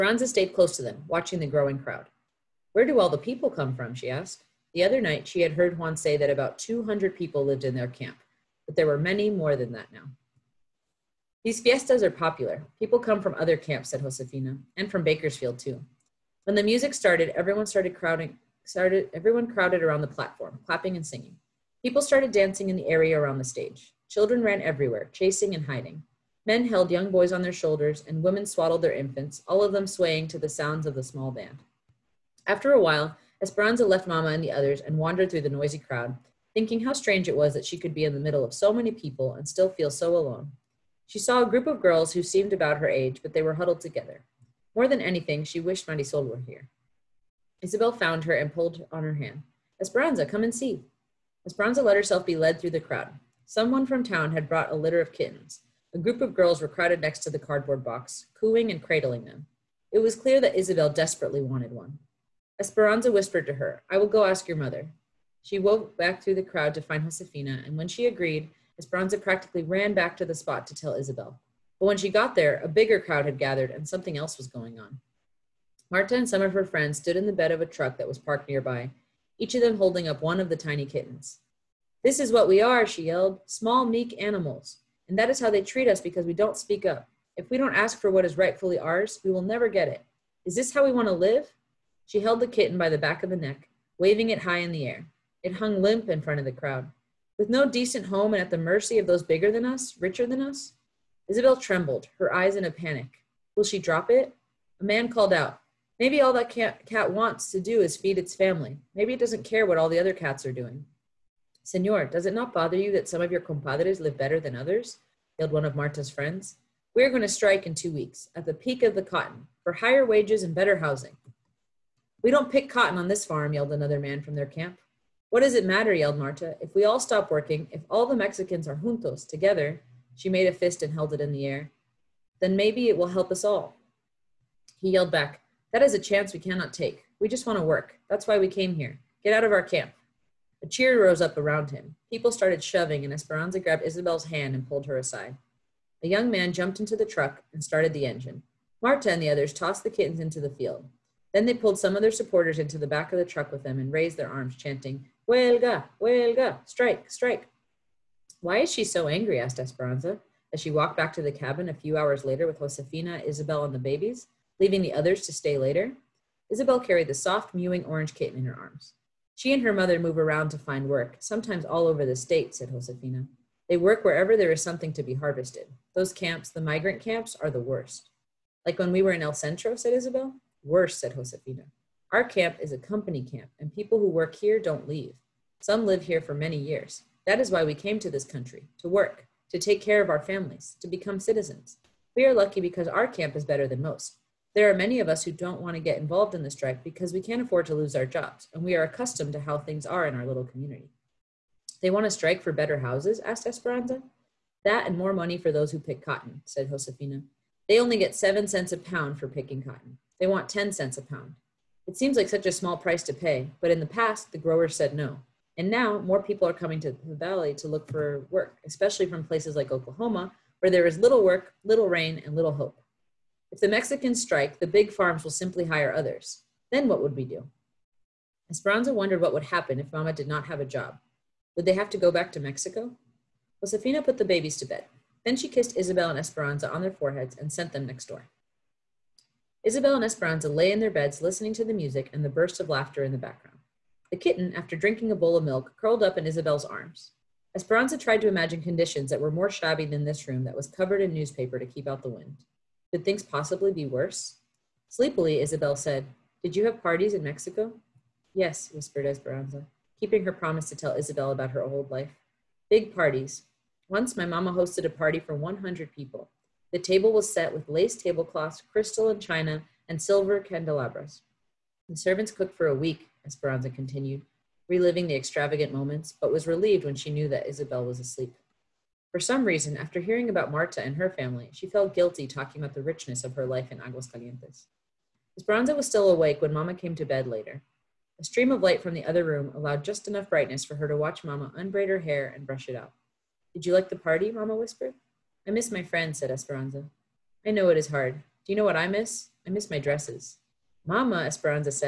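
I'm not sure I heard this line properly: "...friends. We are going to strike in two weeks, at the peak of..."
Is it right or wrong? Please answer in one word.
right.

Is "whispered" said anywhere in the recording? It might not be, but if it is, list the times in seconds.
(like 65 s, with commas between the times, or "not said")
63 s, 258 s, 294 s.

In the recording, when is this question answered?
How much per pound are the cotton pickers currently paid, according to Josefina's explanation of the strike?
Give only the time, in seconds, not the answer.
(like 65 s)
208 s.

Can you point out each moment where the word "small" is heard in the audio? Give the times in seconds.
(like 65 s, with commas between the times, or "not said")
31 s, 83 s, 212 s.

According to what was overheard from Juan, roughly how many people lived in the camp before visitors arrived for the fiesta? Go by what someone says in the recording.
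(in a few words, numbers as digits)
200.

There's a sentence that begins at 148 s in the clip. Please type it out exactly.
Marta and the others tossed the kittens into the field.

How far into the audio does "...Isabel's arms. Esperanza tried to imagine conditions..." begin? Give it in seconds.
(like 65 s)
246 s.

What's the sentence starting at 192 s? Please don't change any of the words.
We are lucky because our camp is better than most.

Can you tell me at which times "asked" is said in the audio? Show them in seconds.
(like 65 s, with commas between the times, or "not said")
4 s, 159 s, 203 s.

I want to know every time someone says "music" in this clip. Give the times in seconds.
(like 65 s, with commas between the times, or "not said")
16 s, 241 s.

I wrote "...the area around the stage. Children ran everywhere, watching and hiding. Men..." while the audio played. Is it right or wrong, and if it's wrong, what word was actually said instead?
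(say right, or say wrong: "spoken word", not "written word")
wrong: "chasing", not "watching".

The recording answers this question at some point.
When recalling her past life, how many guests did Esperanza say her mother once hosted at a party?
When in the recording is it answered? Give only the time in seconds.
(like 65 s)
265 s.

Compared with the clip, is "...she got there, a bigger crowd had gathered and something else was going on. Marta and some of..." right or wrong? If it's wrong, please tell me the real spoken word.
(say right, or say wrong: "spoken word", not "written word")
right.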